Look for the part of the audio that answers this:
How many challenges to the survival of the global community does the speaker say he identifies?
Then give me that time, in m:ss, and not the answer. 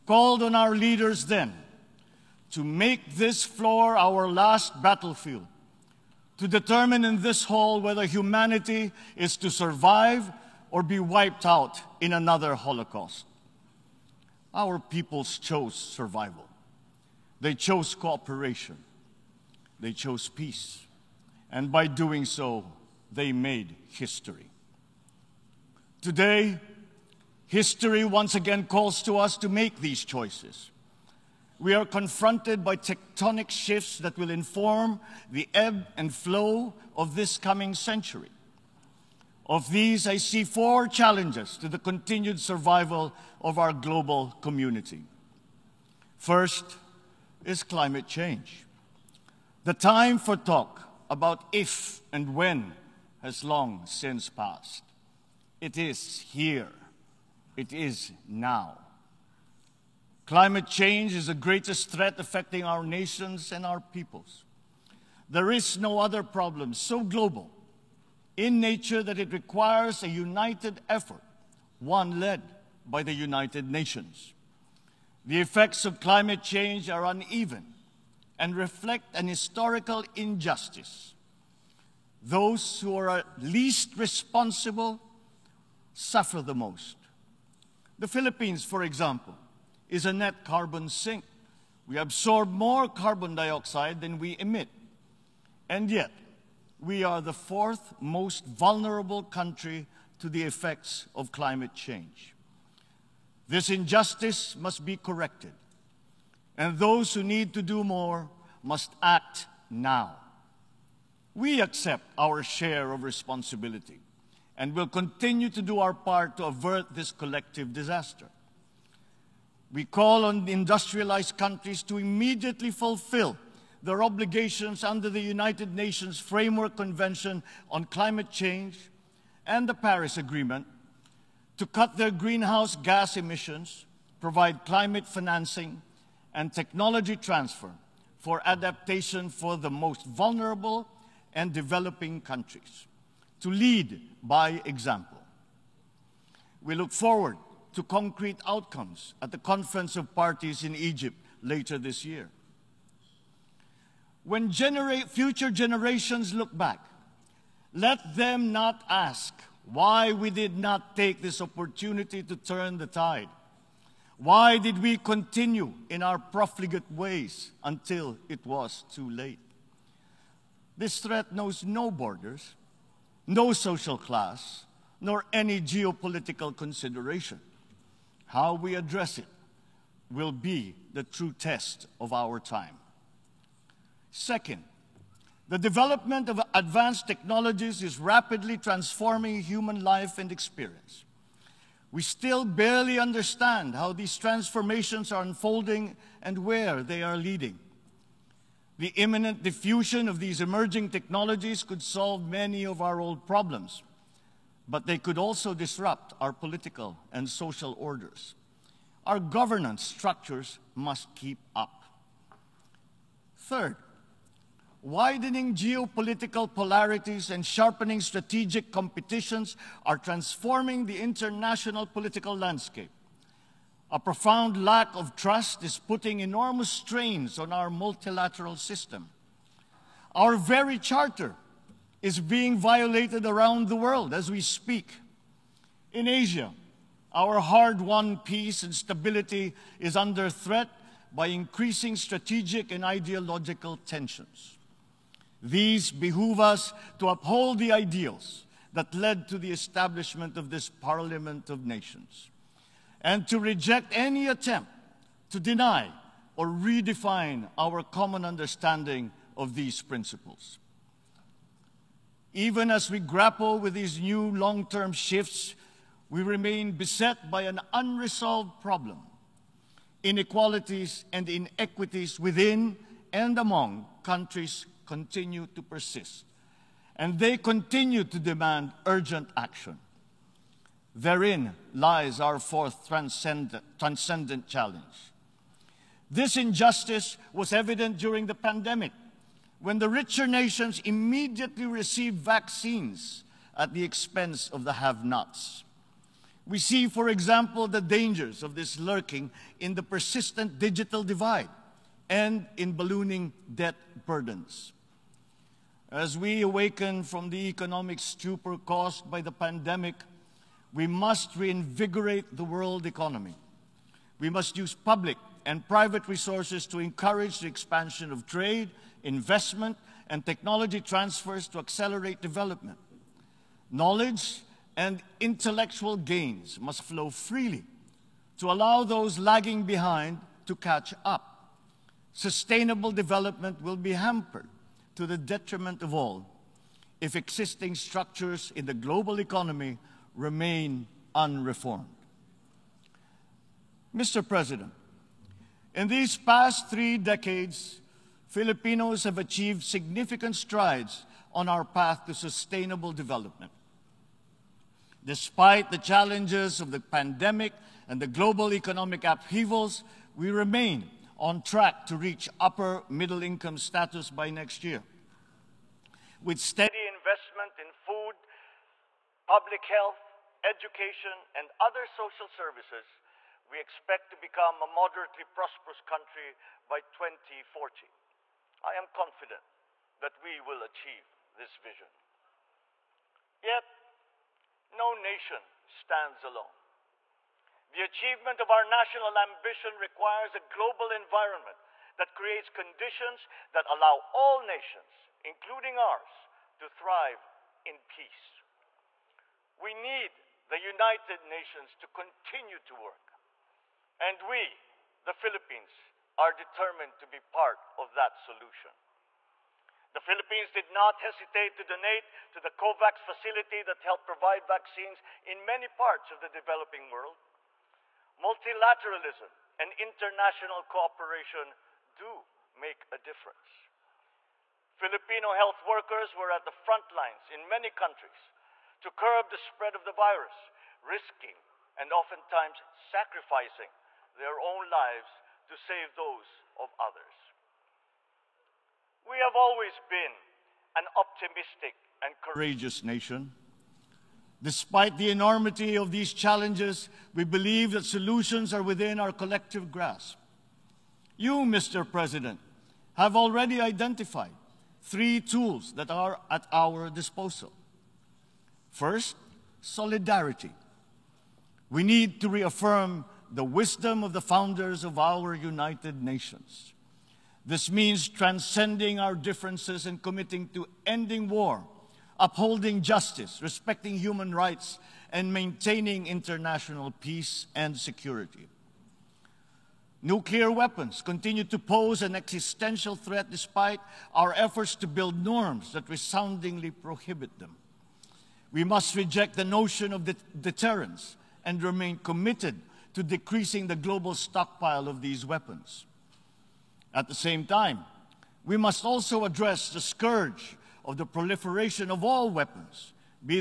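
0:40.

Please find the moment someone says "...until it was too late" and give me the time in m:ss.
2:47.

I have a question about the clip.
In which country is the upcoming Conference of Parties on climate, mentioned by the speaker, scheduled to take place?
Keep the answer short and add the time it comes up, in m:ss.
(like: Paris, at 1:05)
Egypt, at 2:30.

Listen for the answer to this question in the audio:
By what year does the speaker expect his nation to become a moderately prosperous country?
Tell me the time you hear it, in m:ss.
6:16.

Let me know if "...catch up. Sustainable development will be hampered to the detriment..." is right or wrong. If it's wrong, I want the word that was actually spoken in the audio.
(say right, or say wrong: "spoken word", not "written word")
right.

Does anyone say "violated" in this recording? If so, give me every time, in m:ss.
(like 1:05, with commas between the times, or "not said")
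3:52.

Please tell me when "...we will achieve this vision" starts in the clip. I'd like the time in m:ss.
6:20.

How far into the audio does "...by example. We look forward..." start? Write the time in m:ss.
2:24.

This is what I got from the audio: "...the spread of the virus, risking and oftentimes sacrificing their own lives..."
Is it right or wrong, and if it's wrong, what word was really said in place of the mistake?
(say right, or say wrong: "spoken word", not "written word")
right.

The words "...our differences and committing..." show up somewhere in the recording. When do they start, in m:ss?
7:48.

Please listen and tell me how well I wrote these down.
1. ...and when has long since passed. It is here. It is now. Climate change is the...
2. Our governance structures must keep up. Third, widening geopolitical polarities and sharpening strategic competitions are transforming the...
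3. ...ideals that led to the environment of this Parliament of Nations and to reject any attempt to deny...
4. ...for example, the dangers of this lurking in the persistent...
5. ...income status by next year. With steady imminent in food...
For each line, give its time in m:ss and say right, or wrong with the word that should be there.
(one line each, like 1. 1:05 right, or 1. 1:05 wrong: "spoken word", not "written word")
1. 0:52 right
2. 3:29 right
3. 4:07 wrong: "establishment", not "environment"
4. 4:56 right
5. 6:03 wrong: "investment", not "imminent".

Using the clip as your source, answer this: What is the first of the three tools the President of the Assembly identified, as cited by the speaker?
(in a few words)
solidarity.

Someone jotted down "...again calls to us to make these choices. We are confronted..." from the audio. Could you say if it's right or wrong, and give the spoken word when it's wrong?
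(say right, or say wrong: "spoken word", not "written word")
right.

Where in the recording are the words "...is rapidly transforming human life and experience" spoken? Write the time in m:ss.
3:07.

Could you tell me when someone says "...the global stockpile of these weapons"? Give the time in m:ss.
8:13.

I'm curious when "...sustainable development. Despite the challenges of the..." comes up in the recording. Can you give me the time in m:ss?
5:52.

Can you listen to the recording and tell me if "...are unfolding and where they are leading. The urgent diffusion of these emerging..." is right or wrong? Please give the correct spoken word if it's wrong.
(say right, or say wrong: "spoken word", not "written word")
wrong: "imminent", not "urgent".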